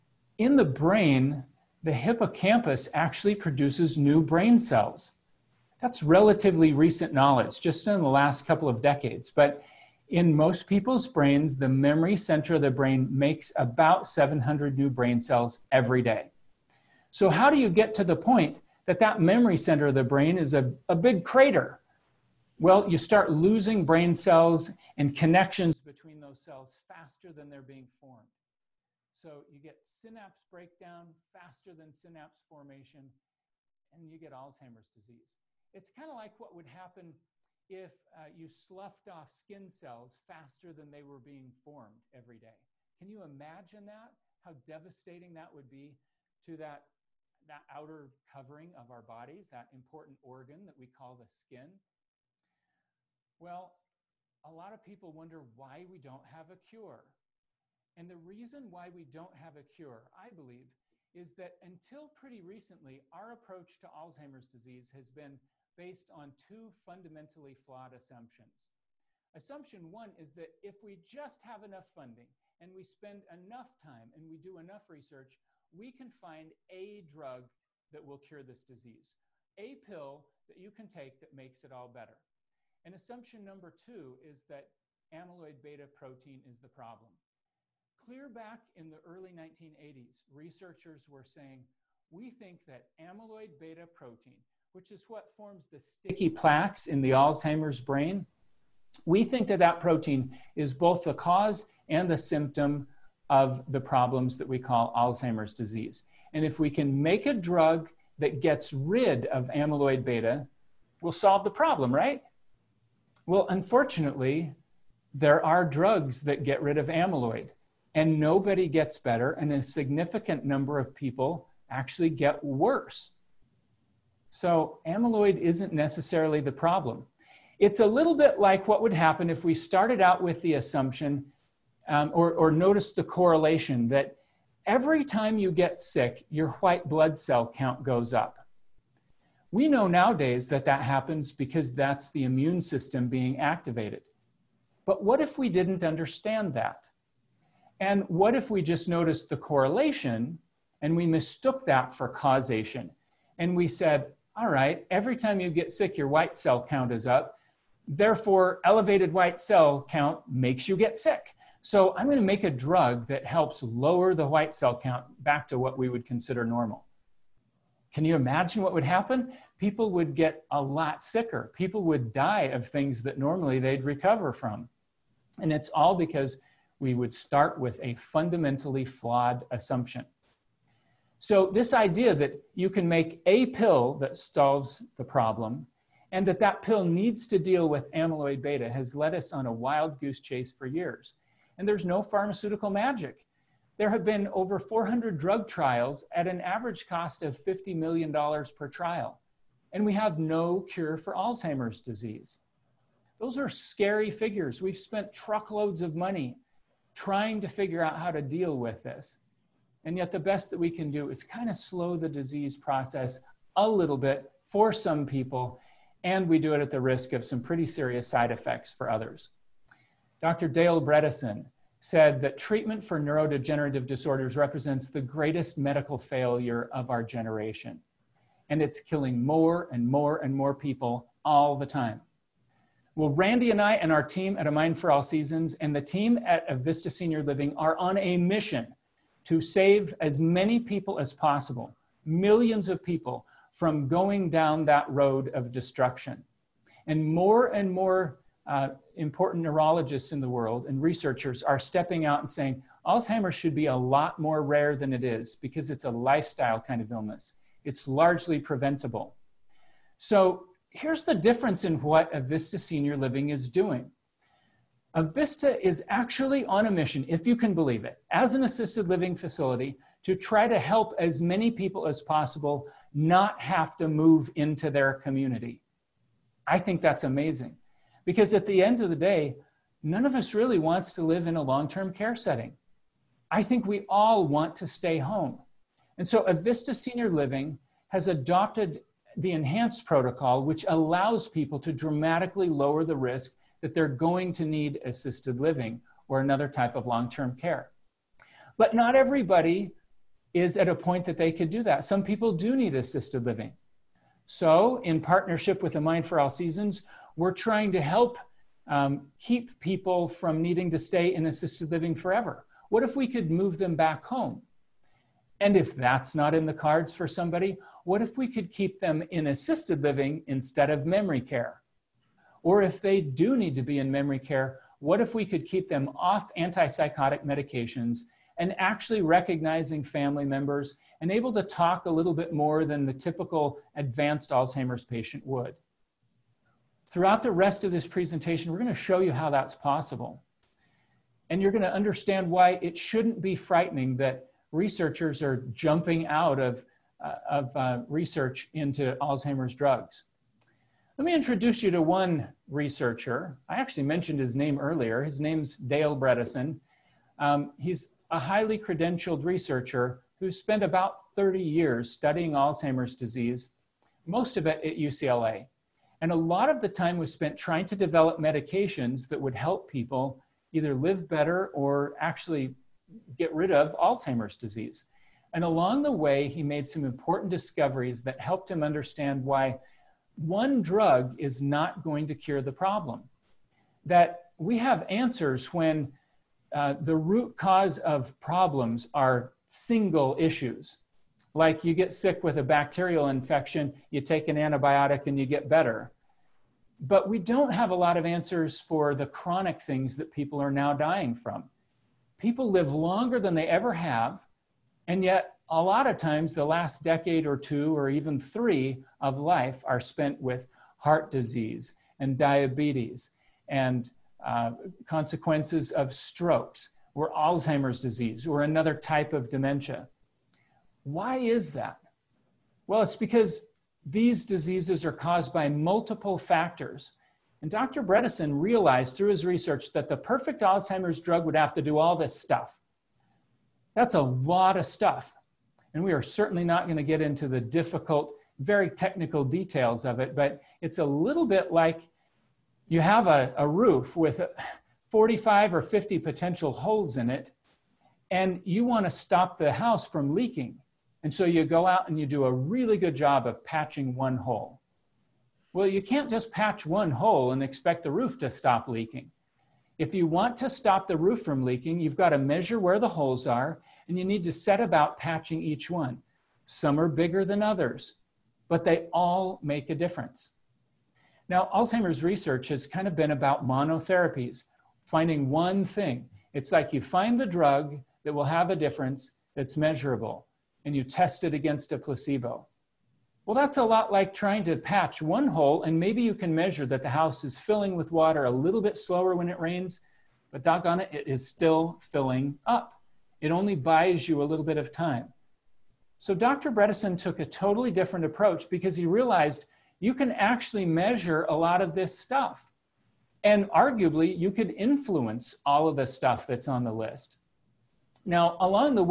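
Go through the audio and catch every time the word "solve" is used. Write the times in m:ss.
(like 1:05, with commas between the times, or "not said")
1:51, 3:04.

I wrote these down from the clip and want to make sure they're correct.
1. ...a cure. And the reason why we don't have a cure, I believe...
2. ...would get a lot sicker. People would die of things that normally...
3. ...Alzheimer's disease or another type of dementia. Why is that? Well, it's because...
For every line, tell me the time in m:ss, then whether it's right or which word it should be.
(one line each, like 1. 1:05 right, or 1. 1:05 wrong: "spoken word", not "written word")
1. 0:56 right
2. 2:49 right
3. 6:57 right.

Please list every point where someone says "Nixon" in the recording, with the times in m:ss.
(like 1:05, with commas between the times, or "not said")
not said.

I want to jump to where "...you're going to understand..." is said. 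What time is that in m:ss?
5:41.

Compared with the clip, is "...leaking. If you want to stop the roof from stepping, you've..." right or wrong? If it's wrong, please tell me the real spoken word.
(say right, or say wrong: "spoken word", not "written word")
wrong: "leaking", not "stepping".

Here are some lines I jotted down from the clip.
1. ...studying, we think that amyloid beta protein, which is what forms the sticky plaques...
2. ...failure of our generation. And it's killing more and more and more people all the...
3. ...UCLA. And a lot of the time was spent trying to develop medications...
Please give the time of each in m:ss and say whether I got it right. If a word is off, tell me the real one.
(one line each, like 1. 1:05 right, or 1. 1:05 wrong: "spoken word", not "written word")
1. 1:31 wrong: "saying", not "studying"
2. 3:45 right
3. 6:04 right.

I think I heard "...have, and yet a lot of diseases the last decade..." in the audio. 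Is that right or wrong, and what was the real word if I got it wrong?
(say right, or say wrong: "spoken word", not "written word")
wrong: "times", not "diseases".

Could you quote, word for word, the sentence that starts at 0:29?
So you get synapse breakdown faster than synapse formation, and you get Alzheimer's disease.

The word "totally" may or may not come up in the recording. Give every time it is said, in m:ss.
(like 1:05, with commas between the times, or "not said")
8:17.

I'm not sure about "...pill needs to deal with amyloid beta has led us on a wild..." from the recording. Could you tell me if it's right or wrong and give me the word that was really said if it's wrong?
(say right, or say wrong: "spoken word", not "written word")
right.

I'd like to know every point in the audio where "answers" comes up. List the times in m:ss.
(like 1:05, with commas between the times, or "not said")
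6:24, 6:38.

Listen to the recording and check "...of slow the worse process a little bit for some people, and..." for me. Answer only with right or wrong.
wrong.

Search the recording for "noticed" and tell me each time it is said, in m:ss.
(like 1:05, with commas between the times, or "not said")
2:12, 2:28.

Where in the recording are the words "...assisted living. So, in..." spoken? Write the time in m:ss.
5:02.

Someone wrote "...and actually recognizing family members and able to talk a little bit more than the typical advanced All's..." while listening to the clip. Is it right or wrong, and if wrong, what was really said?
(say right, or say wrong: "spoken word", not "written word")
wrong: "Alzheimer", not "All".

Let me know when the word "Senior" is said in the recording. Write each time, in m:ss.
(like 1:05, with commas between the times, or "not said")
3:56, 4:22, 4:46.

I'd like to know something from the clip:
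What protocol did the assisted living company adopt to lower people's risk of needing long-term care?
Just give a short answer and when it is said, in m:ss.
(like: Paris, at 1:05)
Enhance Protocol, at 4:49.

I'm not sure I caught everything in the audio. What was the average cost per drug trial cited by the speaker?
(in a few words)
$50 million.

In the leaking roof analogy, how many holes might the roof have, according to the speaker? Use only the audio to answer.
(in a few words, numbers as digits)
45 or 50.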